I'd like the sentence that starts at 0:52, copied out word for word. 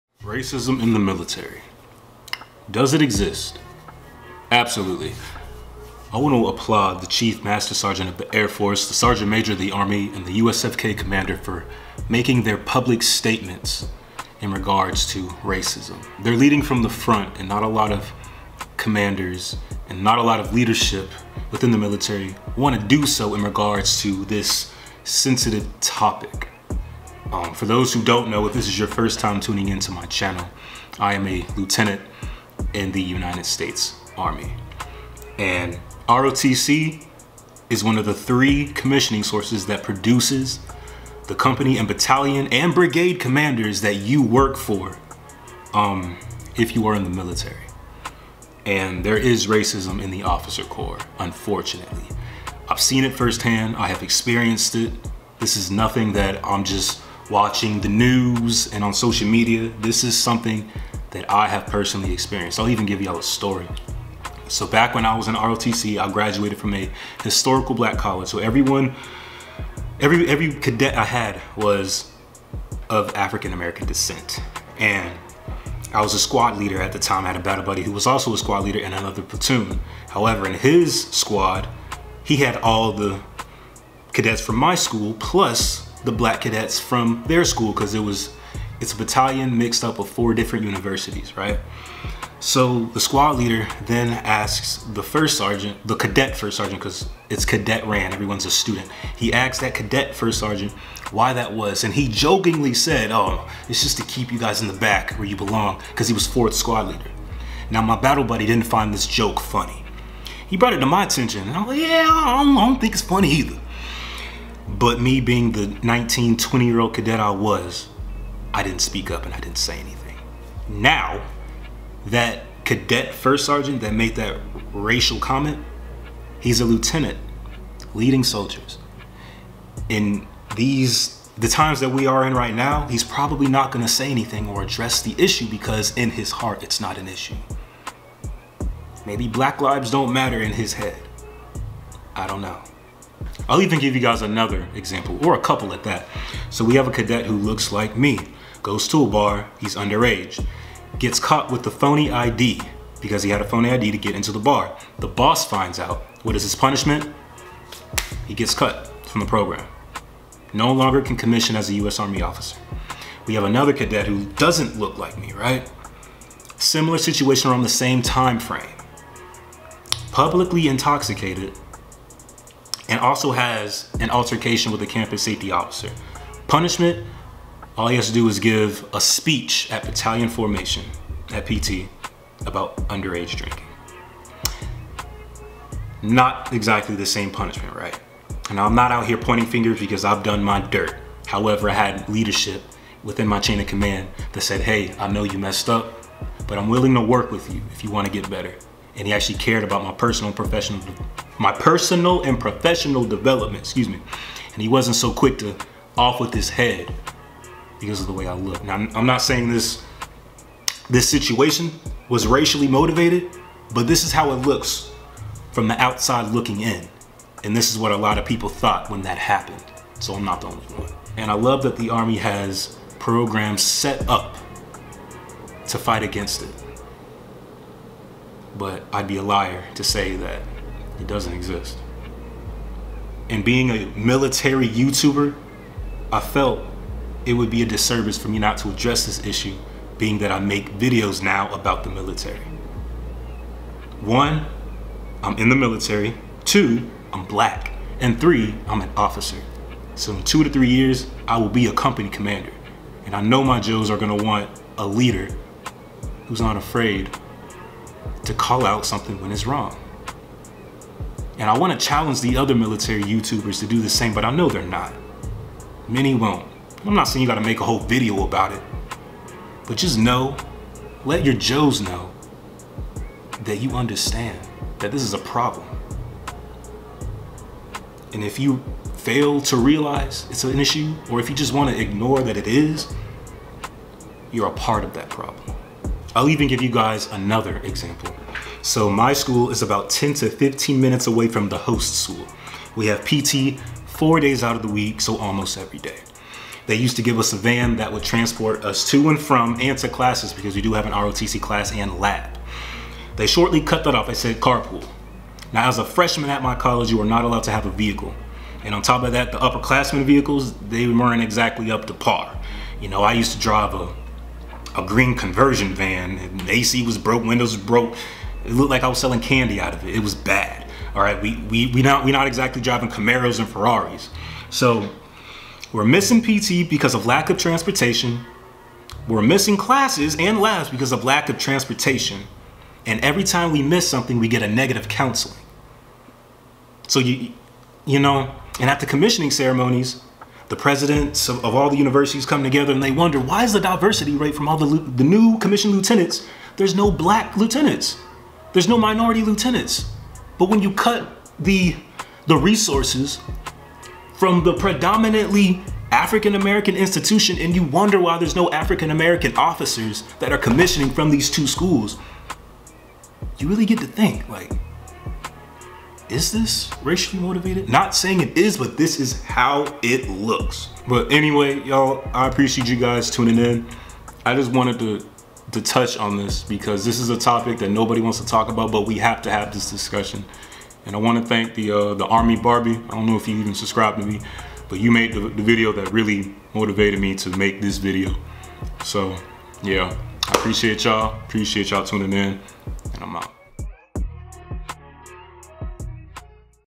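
I've seen it firsthand, I have experienced it.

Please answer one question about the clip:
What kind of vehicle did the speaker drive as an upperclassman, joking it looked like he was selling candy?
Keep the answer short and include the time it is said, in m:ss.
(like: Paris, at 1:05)
Green conversion van, at 5:14.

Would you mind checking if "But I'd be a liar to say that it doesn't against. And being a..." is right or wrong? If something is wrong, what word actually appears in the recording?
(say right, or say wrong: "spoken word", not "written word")
wrong: "exist", not "against".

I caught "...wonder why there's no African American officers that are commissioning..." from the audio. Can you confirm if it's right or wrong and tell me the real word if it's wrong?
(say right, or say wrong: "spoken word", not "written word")
right.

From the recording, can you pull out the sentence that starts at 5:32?
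And every time we miss something, we get a negative counseling.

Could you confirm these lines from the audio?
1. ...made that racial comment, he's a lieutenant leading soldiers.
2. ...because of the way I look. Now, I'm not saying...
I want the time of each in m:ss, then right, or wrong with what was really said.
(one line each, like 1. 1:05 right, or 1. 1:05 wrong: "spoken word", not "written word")
1. 2:03 right
2. 3:27 right.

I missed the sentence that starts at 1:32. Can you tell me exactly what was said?
So the squad leader then asks the first sergeant, the cadet first sergeant, because it's cadet ran, everyone's a student.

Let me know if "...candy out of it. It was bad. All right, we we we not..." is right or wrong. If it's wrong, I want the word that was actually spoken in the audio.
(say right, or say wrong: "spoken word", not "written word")
right.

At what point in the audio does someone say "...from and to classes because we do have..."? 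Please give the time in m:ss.
4:59.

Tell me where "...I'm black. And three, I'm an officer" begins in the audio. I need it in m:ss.
4:07.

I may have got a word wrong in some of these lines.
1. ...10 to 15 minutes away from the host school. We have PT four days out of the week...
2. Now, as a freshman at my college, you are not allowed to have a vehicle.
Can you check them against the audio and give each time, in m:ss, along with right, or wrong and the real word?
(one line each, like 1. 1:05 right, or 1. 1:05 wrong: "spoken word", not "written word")
1. 4:49 right
2. 5:05 right.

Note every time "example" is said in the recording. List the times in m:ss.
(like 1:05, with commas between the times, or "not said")
2:24, 4:47.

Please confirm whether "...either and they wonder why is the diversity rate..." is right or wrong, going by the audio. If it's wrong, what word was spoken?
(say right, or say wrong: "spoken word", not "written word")
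wrong: "together", not "either".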